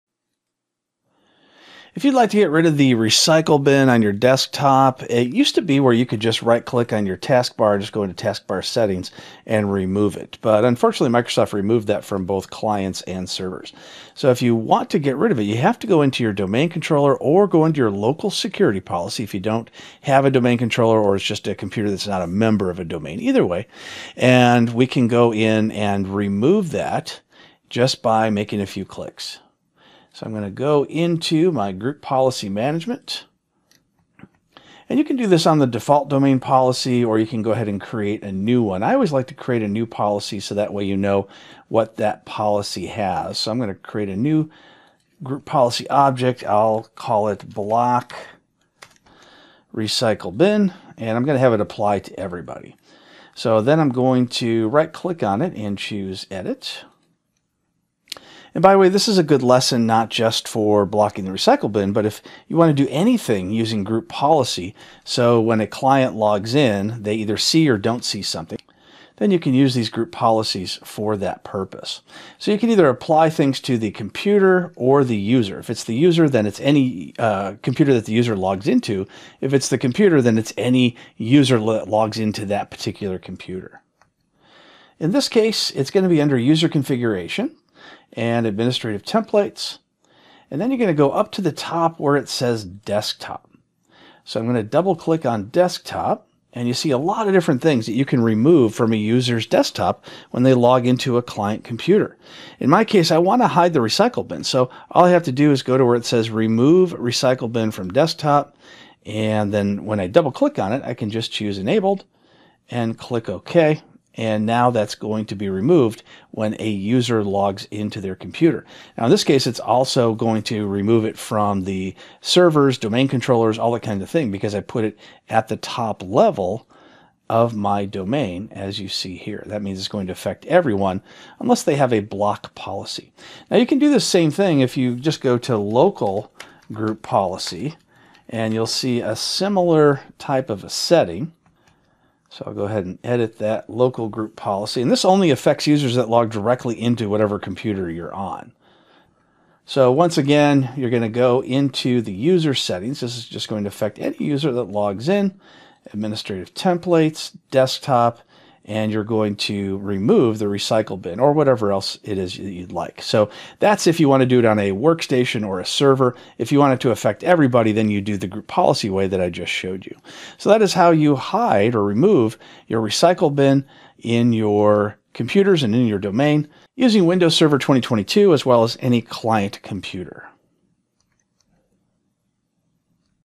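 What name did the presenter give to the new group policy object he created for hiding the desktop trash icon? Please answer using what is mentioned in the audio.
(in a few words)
block recycle bin.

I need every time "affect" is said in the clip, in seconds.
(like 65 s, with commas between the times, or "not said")
130 s, 145 s, 153 s, 166 s.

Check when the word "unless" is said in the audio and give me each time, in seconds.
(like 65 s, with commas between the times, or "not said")
131 s.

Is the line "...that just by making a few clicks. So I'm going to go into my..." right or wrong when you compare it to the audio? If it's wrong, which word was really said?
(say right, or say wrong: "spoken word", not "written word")
right.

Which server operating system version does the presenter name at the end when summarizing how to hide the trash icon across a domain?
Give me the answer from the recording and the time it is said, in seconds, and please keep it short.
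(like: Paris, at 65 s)
Windows Server 2022, at 177 s.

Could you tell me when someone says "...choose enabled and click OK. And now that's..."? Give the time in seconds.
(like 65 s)
111 s.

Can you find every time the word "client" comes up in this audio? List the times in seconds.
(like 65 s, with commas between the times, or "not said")
12 s, 65 s, 101 s, 179 s.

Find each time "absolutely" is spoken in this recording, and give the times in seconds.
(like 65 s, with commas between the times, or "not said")
not said.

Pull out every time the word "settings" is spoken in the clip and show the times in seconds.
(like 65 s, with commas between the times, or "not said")
8 s, 140 s, 152 s.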